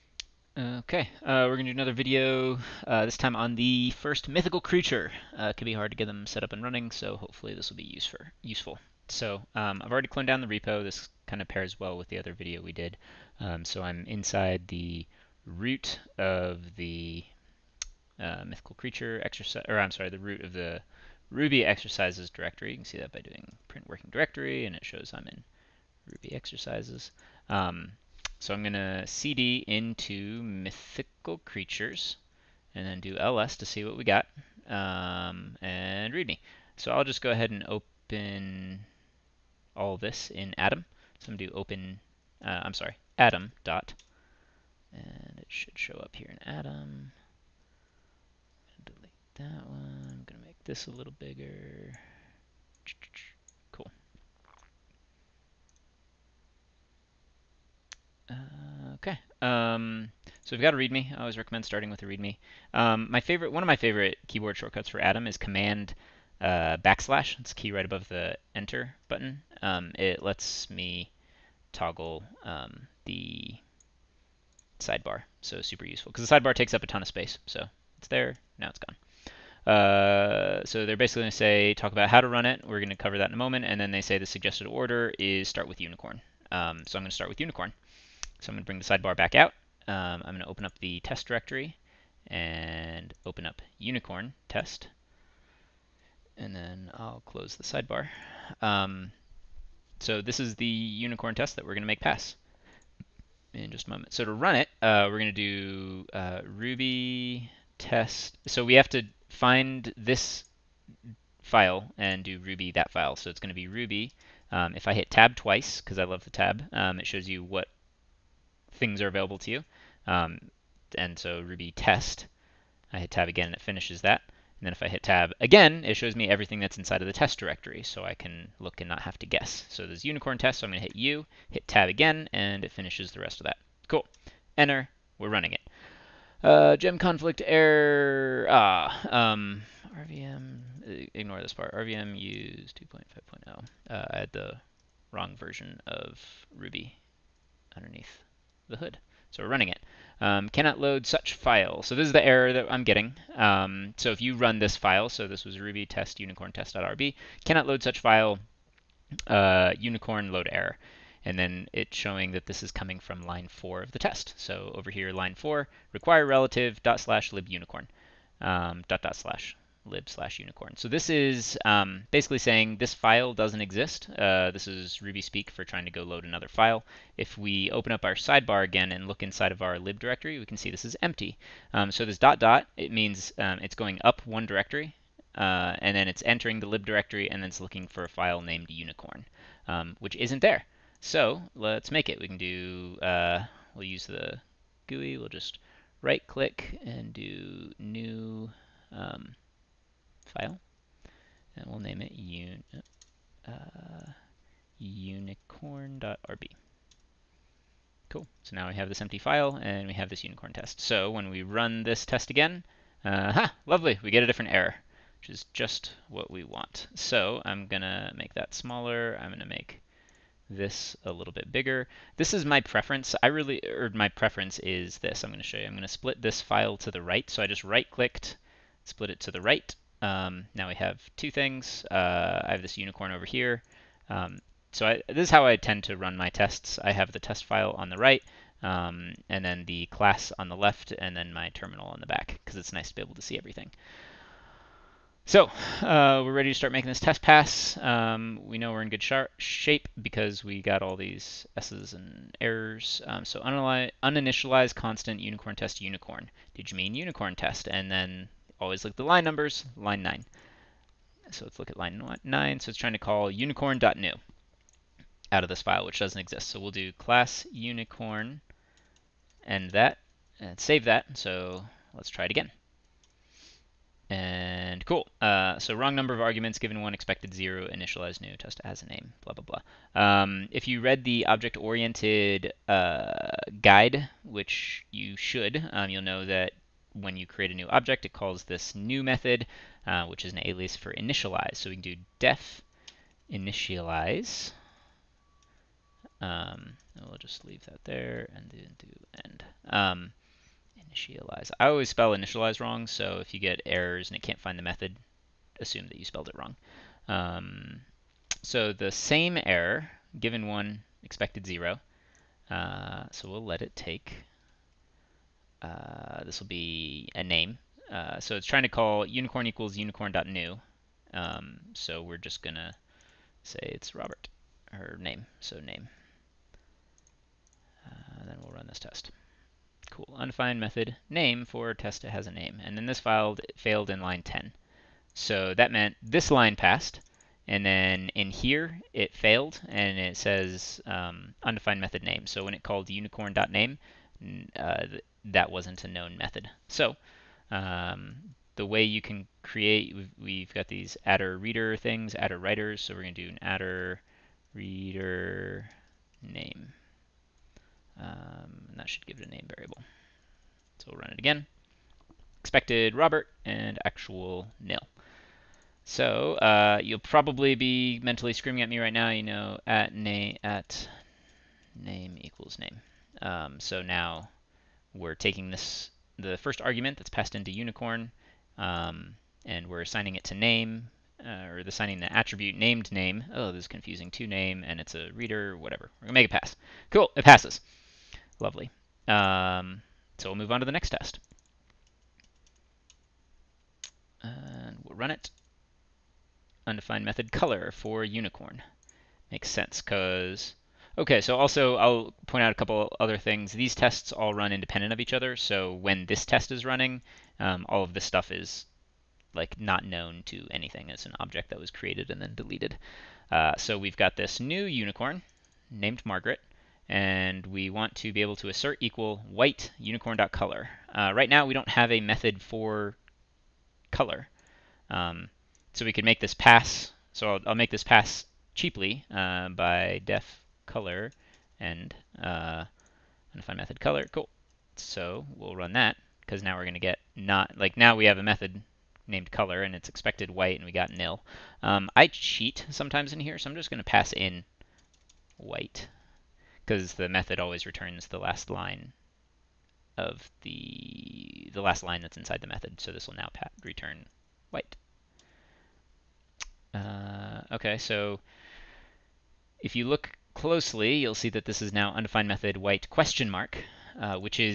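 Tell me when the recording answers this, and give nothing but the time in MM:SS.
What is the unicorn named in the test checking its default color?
06:56.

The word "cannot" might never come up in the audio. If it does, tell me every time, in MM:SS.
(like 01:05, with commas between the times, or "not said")
02:30, 02:37.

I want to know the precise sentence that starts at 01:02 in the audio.
Um, my favorite, one of my favorite keyboard shortcuts for Atom is Command uh, backslash.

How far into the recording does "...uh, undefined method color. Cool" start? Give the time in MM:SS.
07:12.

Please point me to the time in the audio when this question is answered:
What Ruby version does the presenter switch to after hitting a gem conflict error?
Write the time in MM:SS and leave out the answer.
02:22.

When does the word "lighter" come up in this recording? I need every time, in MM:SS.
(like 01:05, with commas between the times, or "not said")
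not said.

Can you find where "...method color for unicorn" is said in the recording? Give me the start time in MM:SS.
06:37.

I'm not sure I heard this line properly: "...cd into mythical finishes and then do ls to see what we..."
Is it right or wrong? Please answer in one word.
wrong.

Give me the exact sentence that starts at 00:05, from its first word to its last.
Uh, it can be hard to get them set up and running, so hopefully this will be use for, useful.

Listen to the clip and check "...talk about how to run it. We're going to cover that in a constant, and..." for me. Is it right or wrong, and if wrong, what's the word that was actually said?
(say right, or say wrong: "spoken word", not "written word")
wrong: "moment", not "constant".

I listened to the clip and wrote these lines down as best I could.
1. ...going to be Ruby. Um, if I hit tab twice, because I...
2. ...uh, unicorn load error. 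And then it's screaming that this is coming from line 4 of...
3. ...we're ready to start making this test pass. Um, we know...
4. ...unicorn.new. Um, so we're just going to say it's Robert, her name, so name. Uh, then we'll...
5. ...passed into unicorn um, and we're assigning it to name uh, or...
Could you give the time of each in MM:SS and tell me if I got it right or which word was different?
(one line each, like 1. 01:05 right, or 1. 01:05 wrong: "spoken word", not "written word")
1. 01:53 right
2. 02:39 wrong: "showing", not "screaming"
3. 04:06 right
4. 05:19 right
5. 06:17 right.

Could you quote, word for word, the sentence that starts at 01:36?
And then I'll close the sidebar.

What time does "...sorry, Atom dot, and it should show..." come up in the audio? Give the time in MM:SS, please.
00:42.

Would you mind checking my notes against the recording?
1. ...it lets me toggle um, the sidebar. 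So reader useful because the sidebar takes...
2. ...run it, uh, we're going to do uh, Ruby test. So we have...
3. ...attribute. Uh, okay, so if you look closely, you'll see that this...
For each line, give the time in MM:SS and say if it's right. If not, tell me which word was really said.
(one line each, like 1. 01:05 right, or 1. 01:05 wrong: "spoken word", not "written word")
1. 01:09 wrong: "super", not "reader"
2. 01:44 right
3. 07:34 wrong: "white", not "attribute".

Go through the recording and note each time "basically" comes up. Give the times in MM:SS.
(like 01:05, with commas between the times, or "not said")
01:20, 02:52.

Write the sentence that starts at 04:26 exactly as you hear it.
So we'll do class unicorn and that, and save that.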